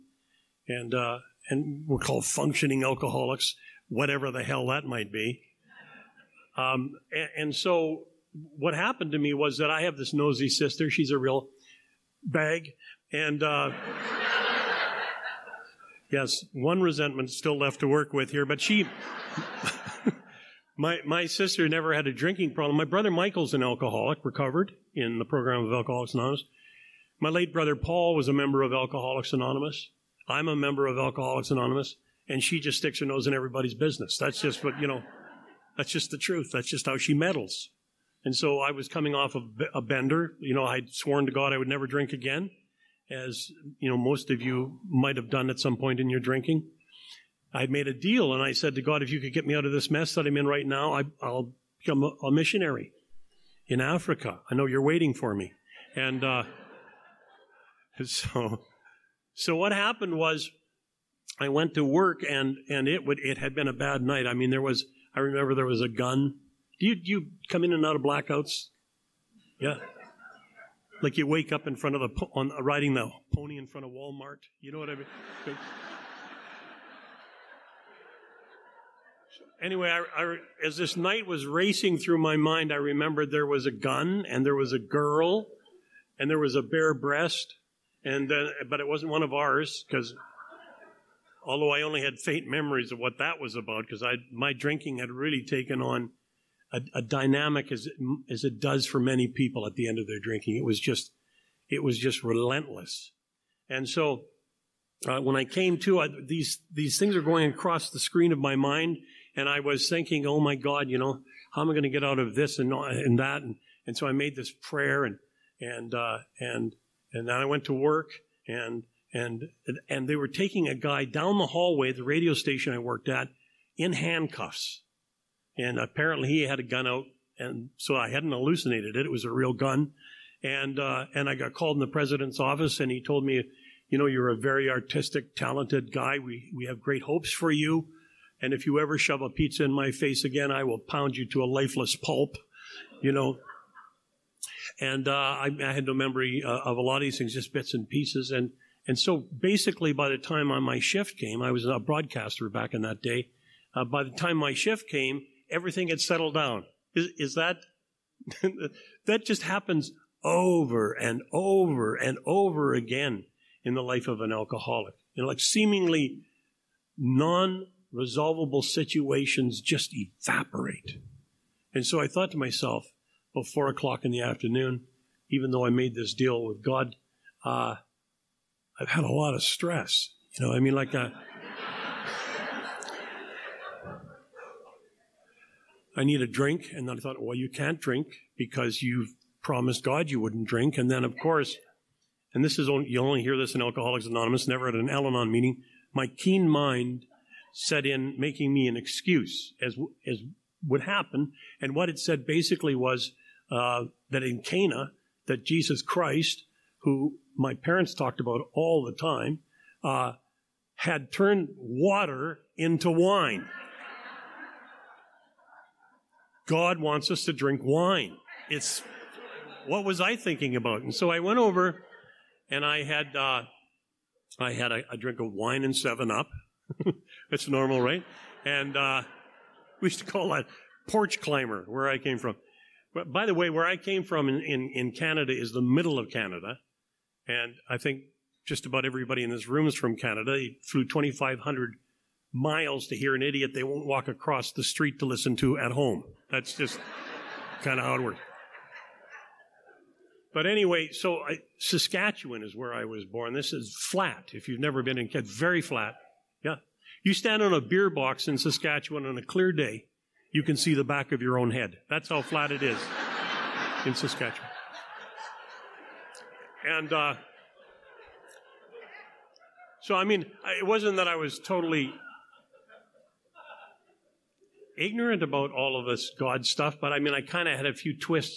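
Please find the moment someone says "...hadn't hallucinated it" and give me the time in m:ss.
2:08.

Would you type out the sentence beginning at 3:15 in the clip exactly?
My keen mind set in making me an excuse as, as would happen.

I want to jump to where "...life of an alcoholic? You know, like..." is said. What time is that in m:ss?
2:43.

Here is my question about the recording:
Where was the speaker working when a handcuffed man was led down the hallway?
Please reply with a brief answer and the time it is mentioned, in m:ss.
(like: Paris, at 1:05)
radio station, at 2:02.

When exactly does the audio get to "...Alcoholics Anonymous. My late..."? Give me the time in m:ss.
0:25.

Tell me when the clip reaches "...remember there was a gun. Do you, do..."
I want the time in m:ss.
1:05.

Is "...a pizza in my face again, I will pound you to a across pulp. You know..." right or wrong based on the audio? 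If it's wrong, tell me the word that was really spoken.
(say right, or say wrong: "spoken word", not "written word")
wrong: "lifeless", not "across".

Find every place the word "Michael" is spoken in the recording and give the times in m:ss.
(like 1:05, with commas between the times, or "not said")
0:23.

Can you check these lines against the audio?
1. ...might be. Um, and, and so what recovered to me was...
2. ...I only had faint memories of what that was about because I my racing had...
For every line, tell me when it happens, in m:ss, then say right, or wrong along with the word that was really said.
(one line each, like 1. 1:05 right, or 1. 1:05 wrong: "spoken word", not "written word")
1. 0:04 wrong: "happened", not "recovered"
2. 1:31 wrong: "drinking", not "racing".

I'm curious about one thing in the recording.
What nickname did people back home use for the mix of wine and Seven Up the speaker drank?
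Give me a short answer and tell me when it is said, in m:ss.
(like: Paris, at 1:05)
porch climber, at 3:50.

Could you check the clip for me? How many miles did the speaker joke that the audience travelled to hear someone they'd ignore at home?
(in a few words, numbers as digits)
2,500.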